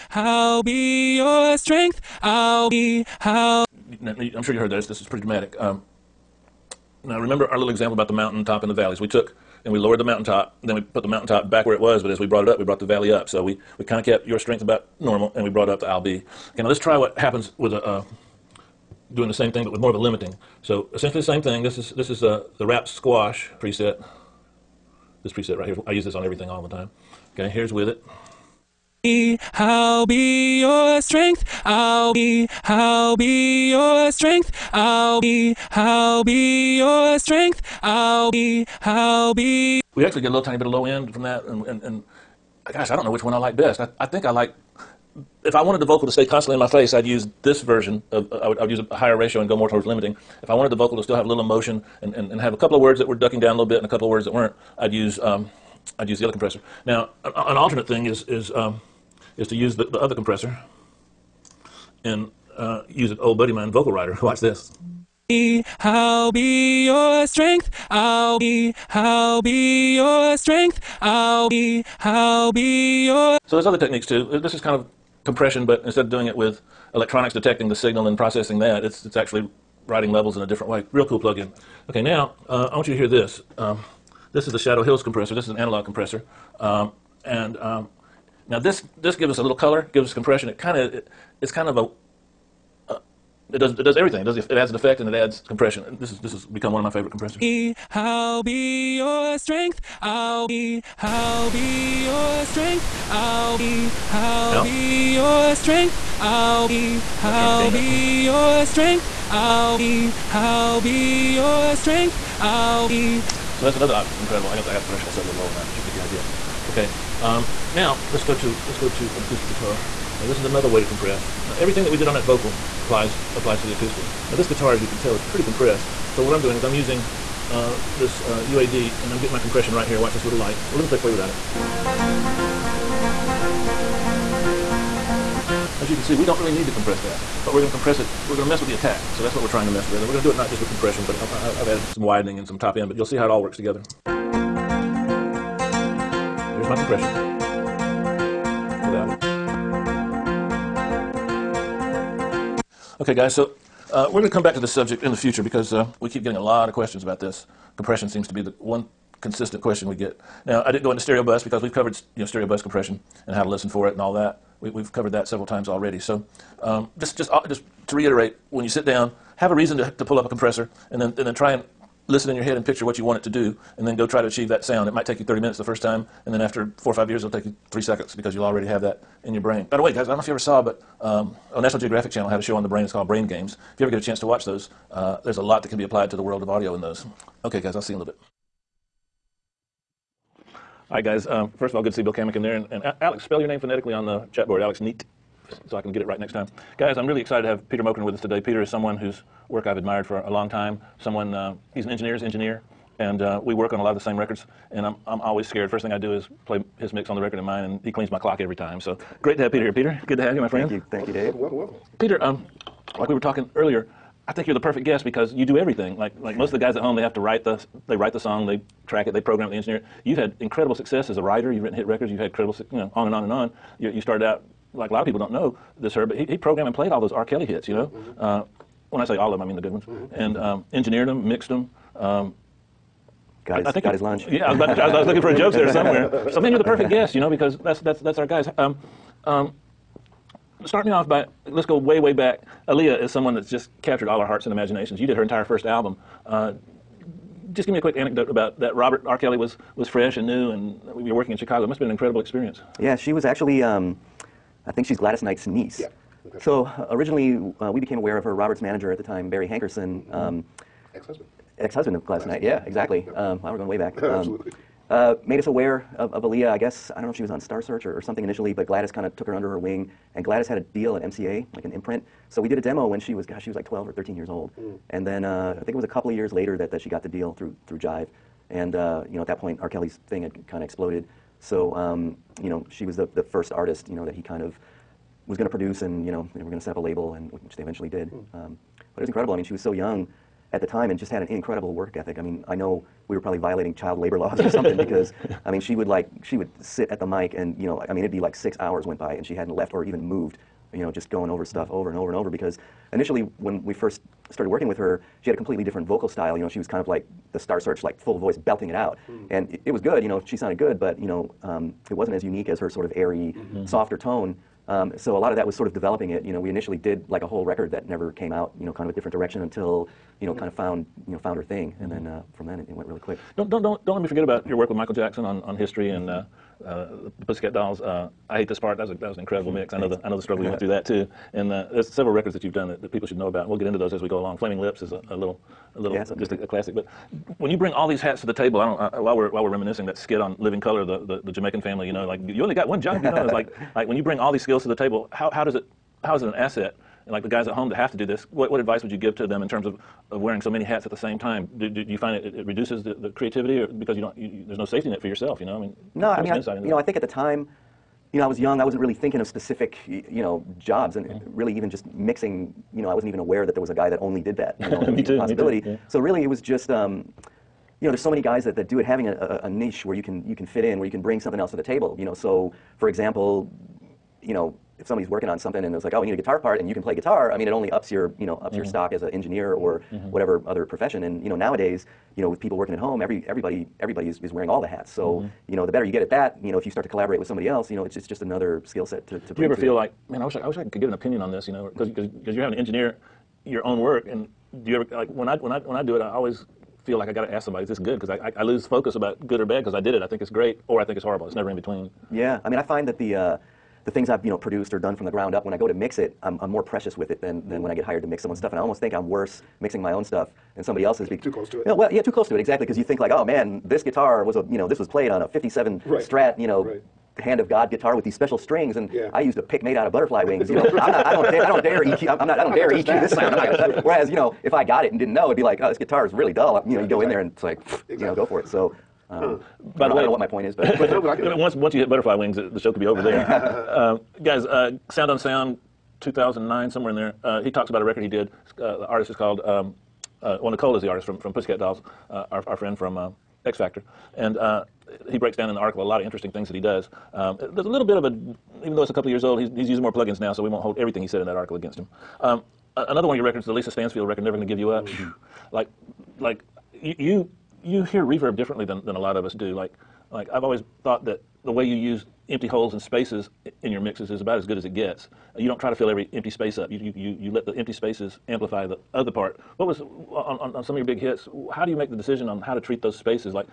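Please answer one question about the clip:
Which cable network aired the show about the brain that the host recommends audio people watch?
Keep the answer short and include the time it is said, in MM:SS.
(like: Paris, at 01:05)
National Geographic Channel, at 03:01.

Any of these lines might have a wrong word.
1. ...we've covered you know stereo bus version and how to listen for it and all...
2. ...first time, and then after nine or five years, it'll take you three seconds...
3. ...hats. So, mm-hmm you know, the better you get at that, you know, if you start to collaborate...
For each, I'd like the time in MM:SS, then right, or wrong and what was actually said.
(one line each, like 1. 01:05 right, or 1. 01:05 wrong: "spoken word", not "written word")
1. 02:41 wrong: "compression", not "version"
2. 02:55 wrong: "four", not "nine"
3. 06:24 right.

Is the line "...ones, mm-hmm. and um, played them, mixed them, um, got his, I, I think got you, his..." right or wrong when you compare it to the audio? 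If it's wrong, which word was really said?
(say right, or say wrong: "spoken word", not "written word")
wrong: "engineered", not "played".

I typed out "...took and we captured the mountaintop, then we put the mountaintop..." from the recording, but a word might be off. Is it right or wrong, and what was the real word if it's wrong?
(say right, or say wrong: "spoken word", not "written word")
wrong: "lowered", not "captured".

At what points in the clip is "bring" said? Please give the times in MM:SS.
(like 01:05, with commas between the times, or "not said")
05:37, 05:44, 06:11, 06:29.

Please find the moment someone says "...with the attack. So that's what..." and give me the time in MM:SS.
02:18.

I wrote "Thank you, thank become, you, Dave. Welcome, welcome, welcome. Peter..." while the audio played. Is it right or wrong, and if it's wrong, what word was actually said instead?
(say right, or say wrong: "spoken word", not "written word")
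wrong: "welcome", not "become".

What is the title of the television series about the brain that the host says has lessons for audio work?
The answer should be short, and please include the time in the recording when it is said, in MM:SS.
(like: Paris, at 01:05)
Brain Games, at 03:03.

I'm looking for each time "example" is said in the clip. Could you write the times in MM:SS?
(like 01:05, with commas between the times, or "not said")
00:07, 06:12.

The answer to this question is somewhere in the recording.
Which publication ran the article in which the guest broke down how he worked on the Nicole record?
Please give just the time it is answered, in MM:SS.
07:14.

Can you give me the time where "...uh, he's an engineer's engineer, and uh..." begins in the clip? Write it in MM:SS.
03:21.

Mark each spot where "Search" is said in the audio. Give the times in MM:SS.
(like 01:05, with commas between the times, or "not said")
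04:27, 05:07.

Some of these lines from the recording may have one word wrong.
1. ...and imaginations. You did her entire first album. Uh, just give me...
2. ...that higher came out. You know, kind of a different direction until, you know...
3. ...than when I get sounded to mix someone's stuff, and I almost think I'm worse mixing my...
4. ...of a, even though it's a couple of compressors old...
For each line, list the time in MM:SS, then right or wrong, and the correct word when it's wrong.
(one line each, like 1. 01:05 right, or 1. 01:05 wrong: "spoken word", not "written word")
1. 04:04 right
2. 05:17 wrong: "never", not "higher"
3. 06:47 wrong: "hired", not "sounded"
4. 07:27 wrong: "years", not "compressors".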